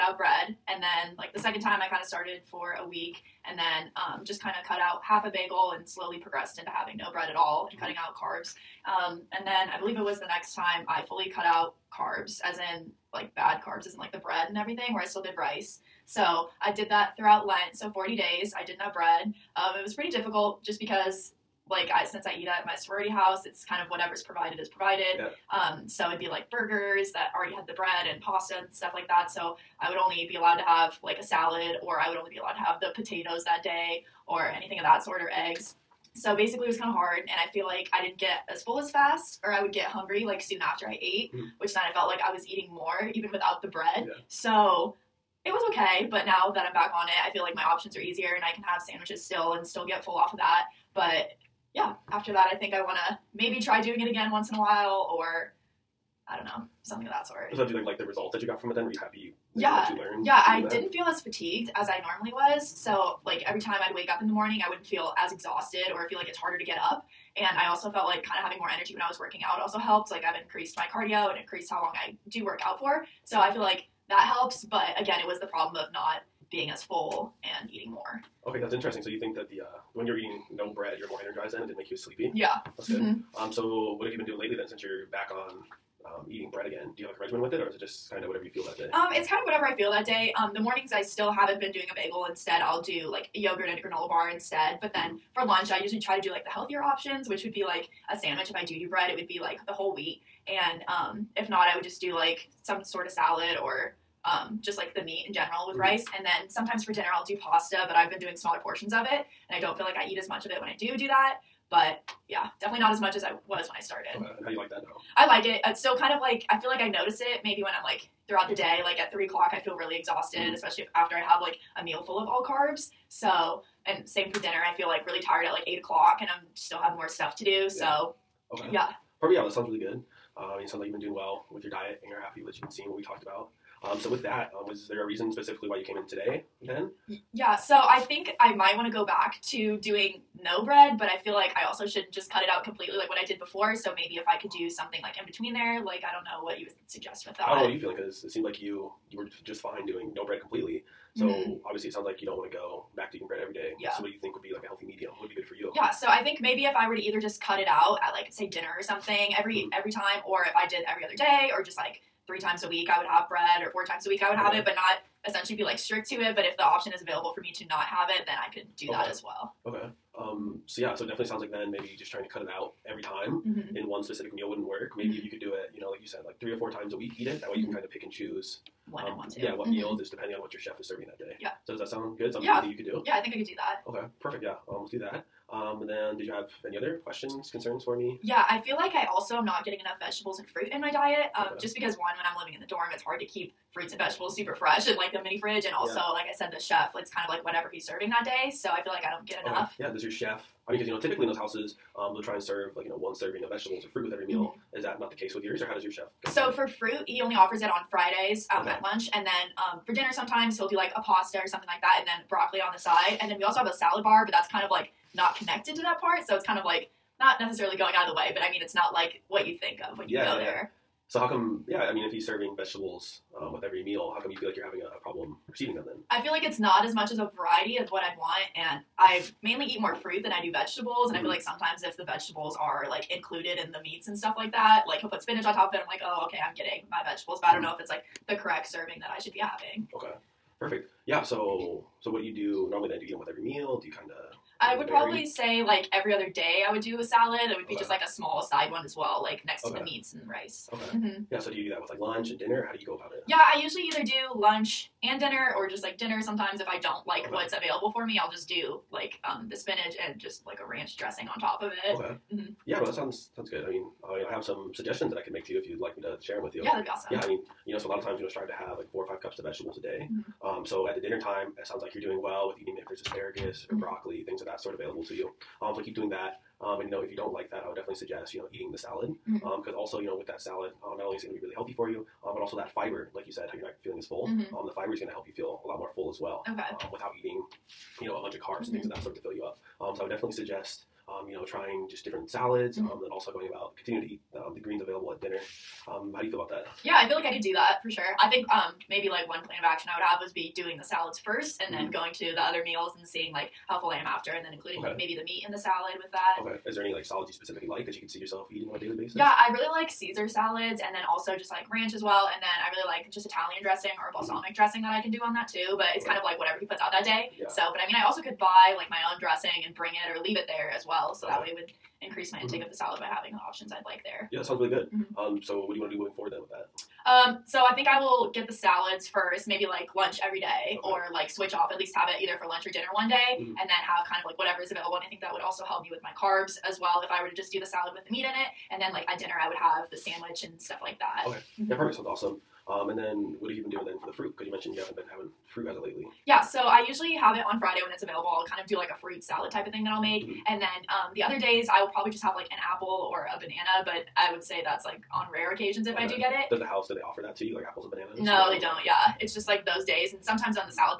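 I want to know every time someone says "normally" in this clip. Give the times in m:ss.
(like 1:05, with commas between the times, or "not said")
1:02, 4:02.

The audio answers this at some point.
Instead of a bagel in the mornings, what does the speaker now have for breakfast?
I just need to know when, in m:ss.
1:33.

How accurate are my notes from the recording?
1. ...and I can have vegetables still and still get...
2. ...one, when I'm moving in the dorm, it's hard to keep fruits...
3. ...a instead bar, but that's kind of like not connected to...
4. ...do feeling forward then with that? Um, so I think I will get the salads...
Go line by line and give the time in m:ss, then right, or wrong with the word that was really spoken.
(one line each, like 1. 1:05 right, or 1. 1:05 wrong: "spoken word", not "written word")
1. 0:48 wrong: "sandwiches", not "vegetables"
2. 3:11 wrong: "living", not "moving"
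3. 3:33 wrong: "salad", not "instead"
4. 5:25 wrong: "moving", not "feeling".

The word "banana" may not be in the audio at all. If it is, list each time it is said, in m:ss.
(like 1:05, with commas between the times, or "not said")
5:53, 5:57.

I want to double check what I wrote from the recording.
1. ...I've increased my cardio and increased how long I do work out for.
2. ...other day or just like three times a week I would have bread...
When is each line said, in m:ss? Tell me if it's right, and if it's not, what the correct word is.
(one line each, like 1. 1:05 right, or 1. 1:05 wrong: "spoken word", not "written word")
1. 1:10 right
2. 2:41 right.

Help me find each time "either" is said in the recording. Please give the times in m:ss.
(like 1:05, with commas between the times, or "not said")
2:36, 4:13, 5:32.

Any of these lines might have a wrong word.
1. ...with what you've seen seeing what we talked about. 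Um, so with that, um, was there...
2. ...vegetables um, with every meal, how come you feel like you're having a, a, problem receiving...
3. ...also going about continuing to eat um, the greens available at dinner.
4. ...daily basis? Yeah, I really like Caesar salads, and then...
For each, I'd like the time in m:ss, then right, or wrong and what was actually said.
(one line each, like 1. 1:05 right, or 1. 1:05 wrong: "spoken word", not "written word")
1. 2:12 right
2. 3:42 right
3. 4:53 right
4. 5:08 right.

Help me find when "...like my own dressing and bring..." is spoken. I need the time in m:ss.
5:18.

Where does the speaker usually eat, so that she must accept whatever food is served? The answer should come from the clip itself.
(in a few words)
sorority house.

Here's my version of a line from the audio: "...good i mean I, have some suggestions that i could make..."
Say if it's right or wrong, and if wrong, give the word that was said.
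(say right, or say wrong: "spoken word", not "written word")
right.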